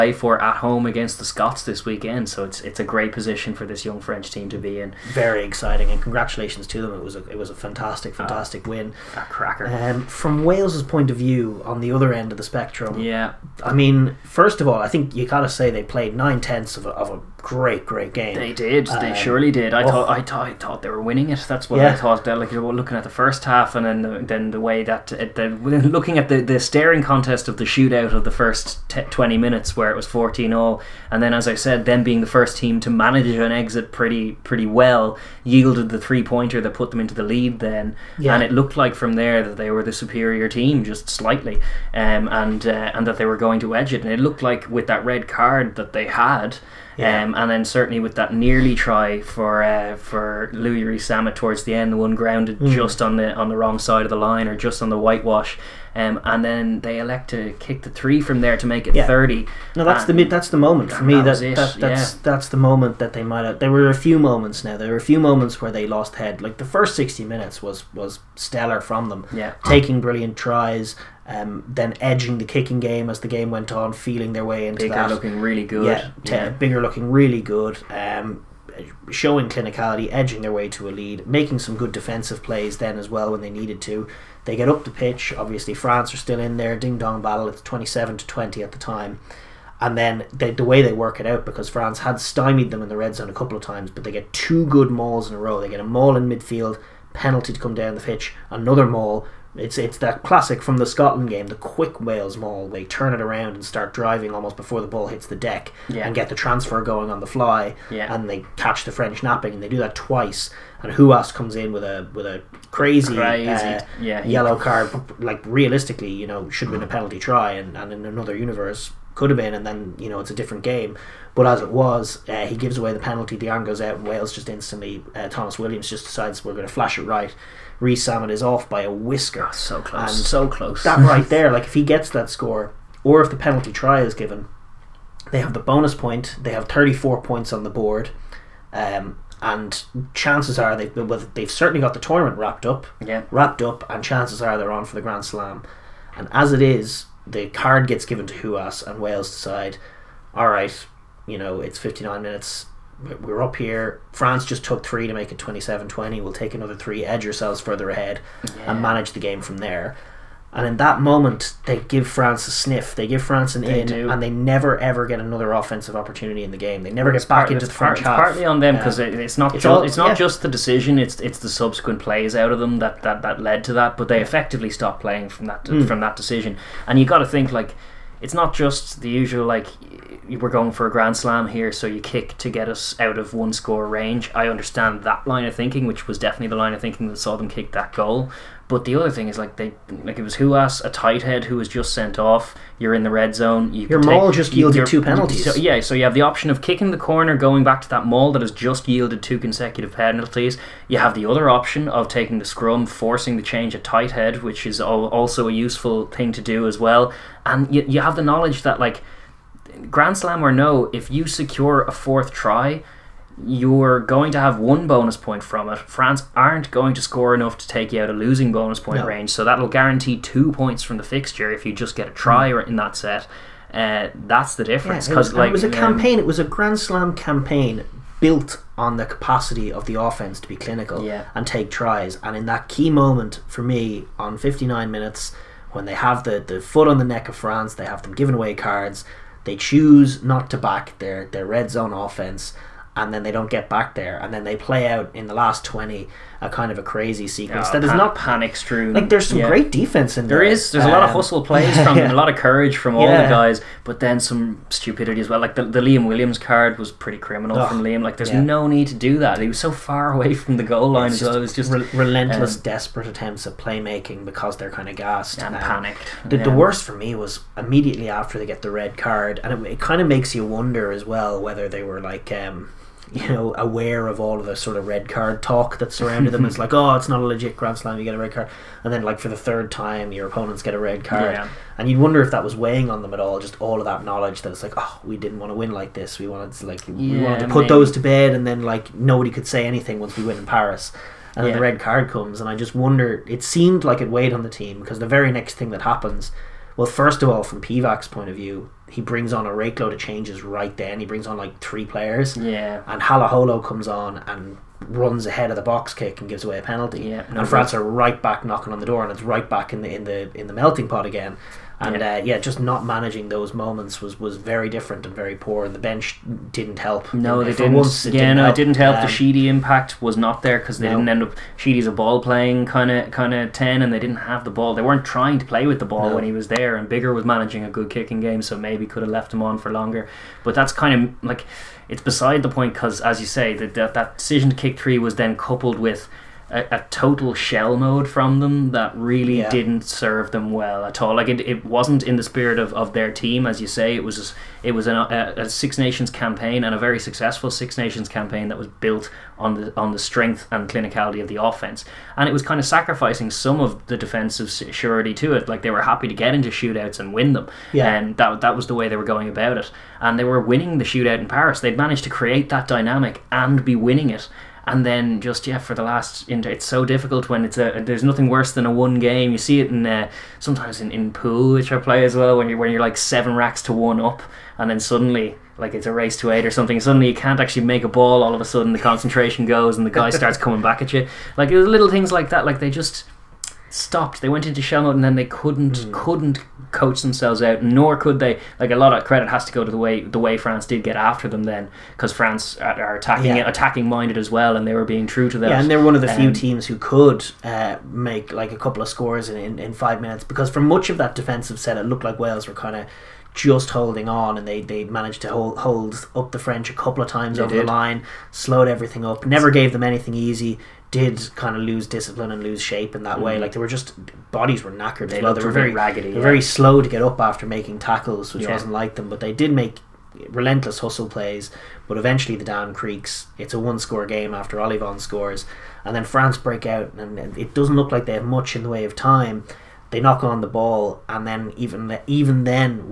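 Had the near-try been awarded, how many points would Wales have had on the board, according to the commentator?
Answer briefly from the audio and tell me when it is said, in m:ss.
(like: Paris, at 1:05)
34, at 2:16.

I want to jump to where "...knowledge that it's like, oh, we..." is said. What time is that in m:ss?
4:44.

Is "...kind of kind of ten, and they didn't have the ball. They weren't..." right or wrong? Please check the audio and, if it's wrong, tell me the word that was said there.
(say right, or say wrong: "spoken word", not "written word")
right.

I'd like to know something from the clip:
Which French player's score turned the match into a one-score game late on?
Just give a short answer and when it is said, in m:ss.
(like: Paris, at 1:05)
Ollivon, at 7:04.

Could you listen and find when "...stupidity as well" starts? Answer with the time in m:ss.
4:14.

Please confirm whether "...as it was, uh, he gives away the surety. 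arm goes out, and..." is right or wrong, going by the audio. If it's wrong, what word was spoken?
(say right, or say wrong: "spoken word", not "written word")
wrong: "penalty", not "surety".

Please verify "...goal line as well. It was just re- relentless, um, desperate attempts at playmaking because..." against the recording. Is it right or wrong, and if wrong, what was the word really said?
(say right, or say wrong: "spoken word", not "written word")
right.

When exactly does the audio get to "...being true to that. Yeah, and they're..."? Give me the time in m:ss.
6:34.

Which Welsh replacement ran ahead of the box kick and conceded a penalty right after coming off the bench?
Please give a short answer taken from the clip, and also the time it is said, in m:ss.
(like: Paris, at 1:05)
Halaholo, at 5:03.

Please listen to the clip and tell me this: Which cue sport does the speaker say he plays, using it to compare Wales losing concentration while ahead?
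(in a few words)
Pool.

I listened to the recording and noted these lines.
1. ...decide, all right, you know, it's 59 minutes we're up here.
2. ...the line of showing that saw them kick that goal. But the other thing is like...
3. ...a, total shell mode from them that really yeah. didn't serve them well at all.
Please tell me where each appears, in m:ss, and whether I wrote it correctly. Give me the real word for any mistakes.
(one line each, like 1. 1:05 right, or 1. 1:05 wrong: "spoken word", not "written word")
1. 2:29 right
2. 3:06 wrong: "thinking", not "showing"
3. 5:36 right.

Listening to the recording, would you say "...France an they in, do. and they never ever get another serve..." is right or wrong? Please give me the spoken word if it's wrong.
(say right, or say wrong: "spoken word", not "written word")
wrong: "offensive", not "serve".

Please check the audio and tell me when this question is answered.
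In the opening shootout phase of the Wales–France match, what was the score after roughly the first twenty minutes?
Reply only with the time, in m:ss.
0:30.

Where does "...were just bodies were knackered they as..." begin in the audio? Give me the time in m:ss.
6:53.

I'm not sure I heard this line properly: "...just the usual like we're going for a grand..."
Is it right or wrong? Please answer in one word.
right.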